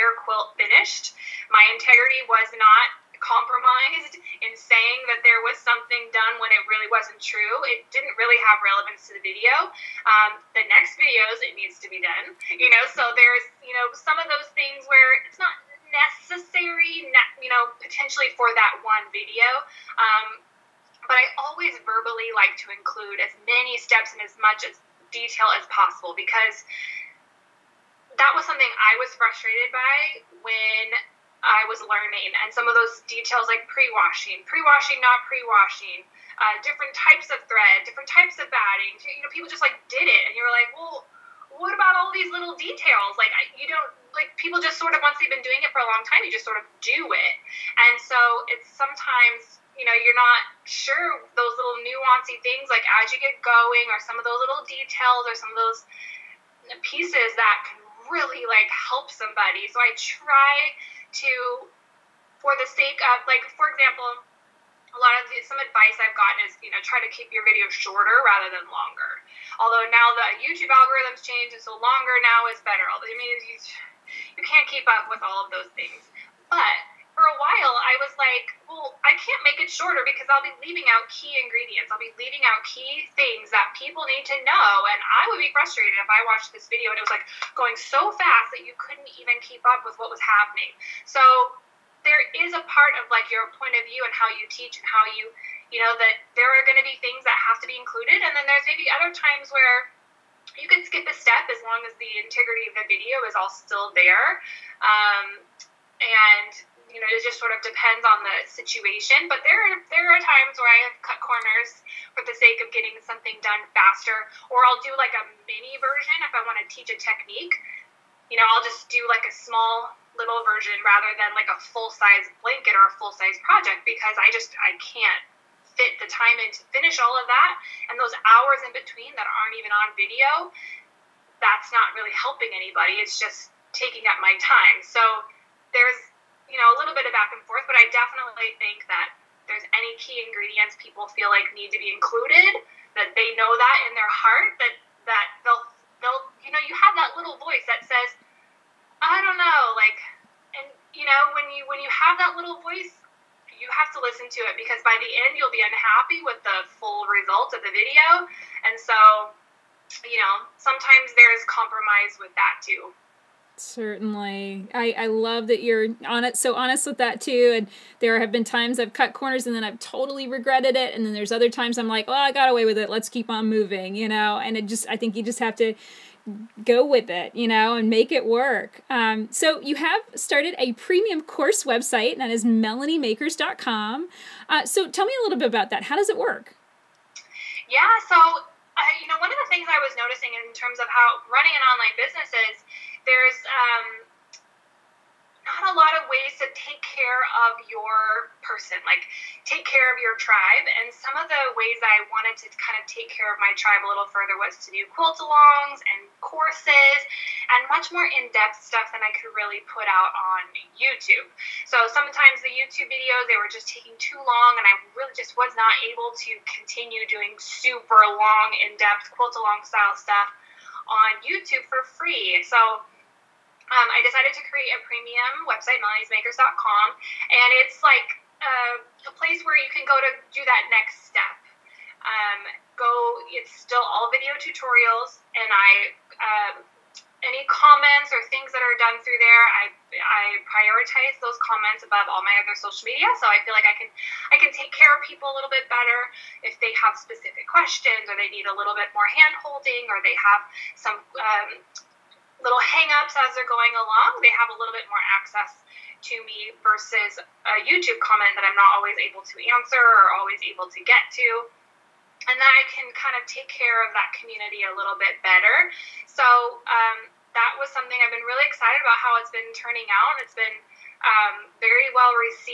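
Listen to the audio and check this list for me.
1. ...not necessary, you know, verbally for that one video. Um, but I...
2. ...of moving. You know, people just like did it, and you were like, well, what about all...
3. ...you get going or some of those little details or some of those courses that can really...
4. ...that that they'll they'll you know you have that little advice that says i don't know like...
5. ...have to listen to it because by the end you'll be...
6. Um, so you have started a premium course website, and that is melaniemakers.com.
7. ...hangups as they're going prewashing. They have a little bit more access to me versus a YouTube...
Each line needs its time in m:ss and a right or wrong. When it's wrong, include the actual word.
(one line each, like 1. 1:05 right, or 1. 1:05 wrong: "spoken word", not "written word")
1. 0:15 wrong: "potentially", not "verbally"
2. 0:38 wrong: "batting", not "moving"
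3. 0:53 wrong: "pieces", not "courses"
4. 2:24 wrong: "voice", not "advice"
5. 2:33 right
6. 2:58 right
7. 4:12 wrong: "along", not "prewashing".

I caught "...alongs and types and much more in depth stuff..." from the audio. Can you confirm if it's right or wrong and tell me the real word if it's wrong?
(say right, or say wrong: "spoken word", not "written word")
wrong: "courses", not "types".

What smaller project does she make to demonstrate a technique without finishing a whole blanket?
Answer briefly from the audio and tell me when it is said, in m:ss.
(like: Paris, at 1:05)
a mini version, at 1:55.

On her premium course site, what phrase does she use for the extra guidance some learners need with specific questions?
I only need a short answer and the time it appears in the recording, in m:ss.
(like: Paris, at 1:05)
hand holding, at 4:09.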